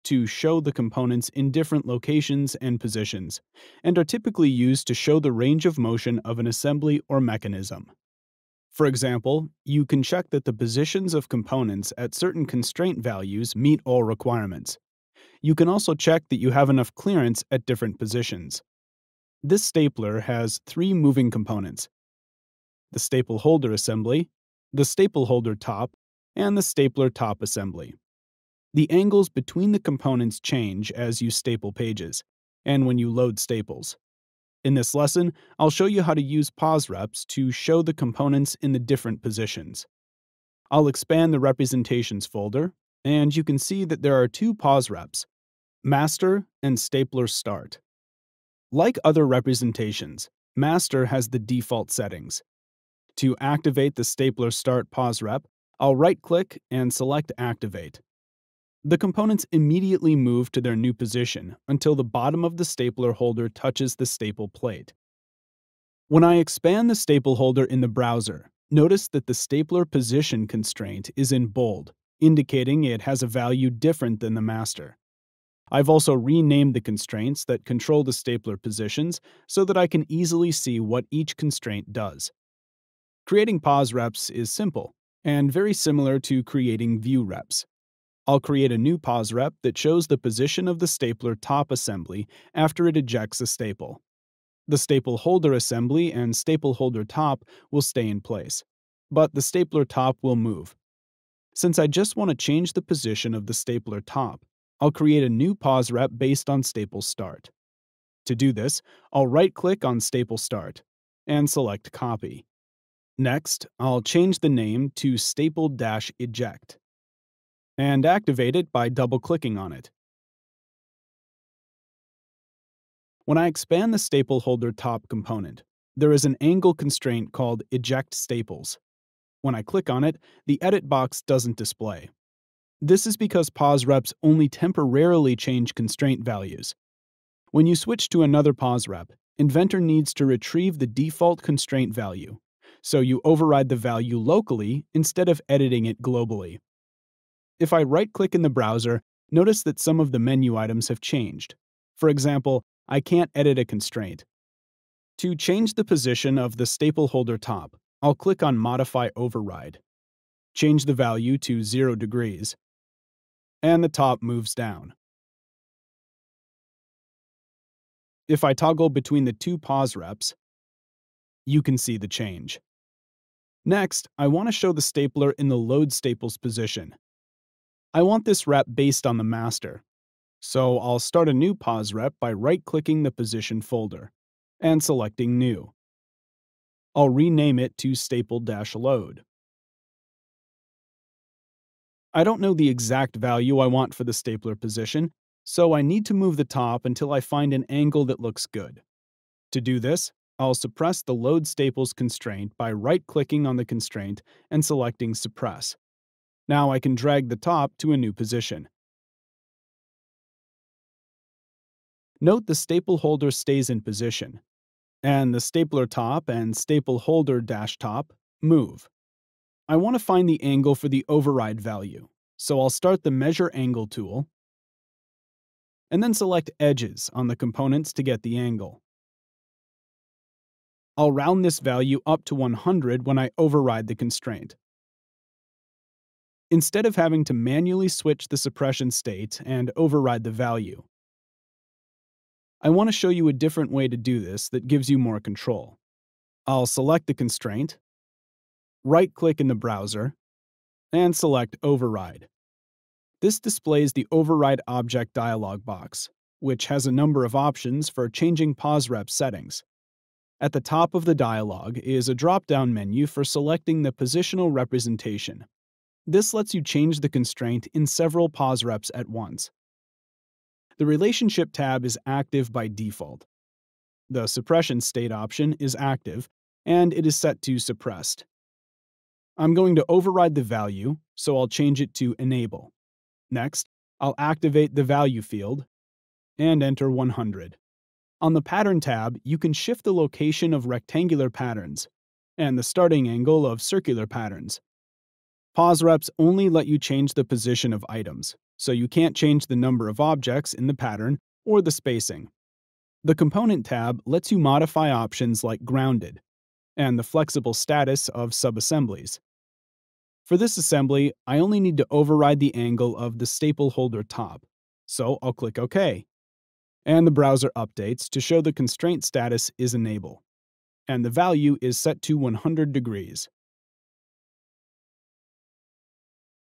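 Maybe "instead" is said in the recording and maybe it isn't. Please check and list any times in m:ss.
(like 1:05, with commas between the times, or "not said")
2:24, 3:56.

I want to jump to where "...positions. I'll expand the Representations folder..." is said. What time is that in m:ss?
0:39.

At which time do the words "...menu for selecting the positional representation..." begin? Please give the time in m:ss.
4:22.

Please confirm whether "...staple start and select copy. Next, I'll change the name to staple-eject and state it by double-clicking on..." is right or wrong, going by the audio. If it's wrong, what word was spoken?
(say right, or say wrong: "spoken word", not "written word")
wrong: "activate", not "state".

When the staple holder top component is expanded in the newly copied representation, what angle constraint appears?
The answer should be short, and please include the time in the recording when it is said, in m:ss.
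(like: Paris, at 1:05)
Eject Staples, at 2:07.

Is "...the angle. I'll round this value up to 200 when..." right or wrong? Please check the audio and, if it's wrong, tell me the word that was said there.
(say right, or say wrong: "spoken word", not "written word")
wrong: "100", not "200".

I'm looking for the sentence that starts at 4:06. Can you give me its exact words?
I'll select the constraint, right-click in the browser, and select Override.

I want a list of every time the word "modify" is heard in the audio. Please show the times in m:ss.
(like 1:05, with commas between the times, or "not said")
2:38, 5:04.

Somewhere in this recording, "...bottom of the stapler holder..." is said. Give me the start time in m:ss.
1:02.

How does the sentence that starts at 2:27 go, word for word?
If I right-click in the browser, notice that some of the menu items have changed.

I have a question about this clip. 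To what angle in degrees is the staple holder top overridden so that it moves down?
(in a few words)
0 degrees.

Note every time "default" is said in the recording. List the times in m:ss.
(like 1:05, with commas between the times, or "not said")
0:51, 2:20, 4:32.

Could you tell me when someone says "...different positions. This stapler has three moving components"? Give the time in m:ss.
0:17.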